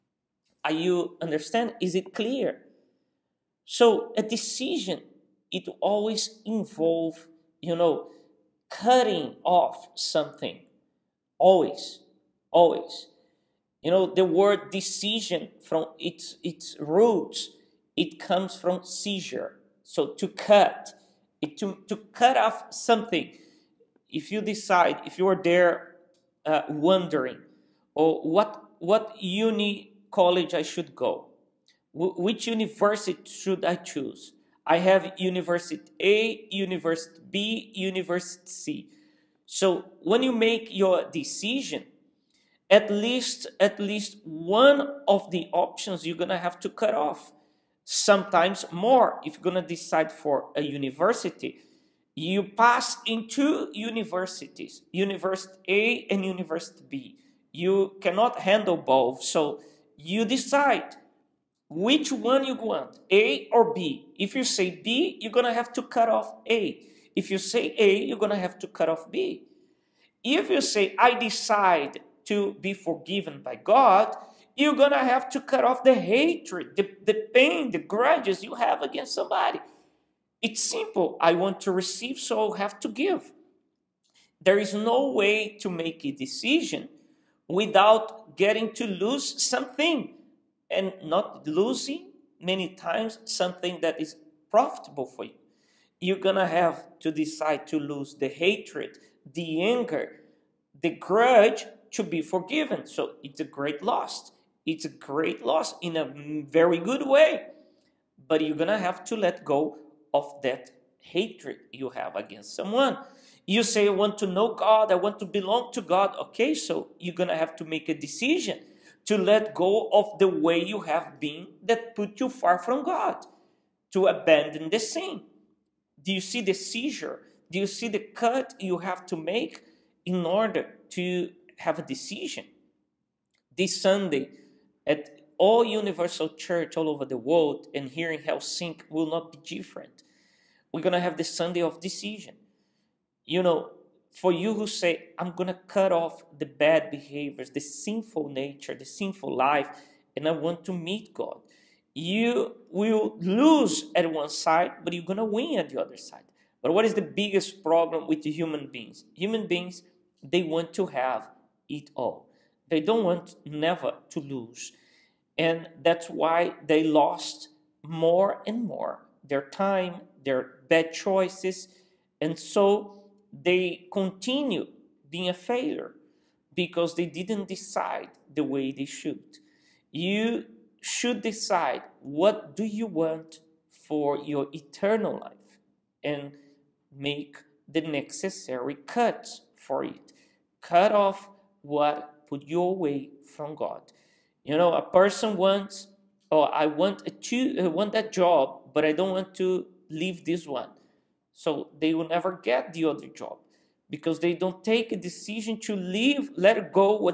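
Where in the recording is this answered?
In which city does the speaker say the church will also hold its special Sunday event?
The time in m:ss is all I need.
2:18.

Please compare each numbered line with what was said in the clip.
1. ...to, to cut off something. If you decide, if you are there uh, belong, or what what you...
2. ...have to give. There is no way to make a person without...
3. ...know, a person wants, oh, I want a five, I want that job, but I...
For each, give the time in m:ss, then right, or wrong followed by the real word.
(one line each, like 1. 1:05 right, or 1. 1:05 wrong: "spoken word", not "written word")
1. 0:21 wrong: "wondering", not "belong"
2. 1:22 wrong: "decision", not "person"
3. 3:14 wrong: "two", not "five".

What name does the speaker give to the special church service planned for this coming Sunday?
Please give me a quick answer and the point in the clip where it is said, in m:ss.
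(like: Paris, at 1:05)
Sunday of decision, at 2:21.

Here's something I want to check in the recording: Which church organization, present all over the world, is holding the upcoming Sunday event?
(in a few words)
Universal Church.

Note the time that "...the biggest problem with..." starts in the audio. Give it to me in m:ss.
2:36.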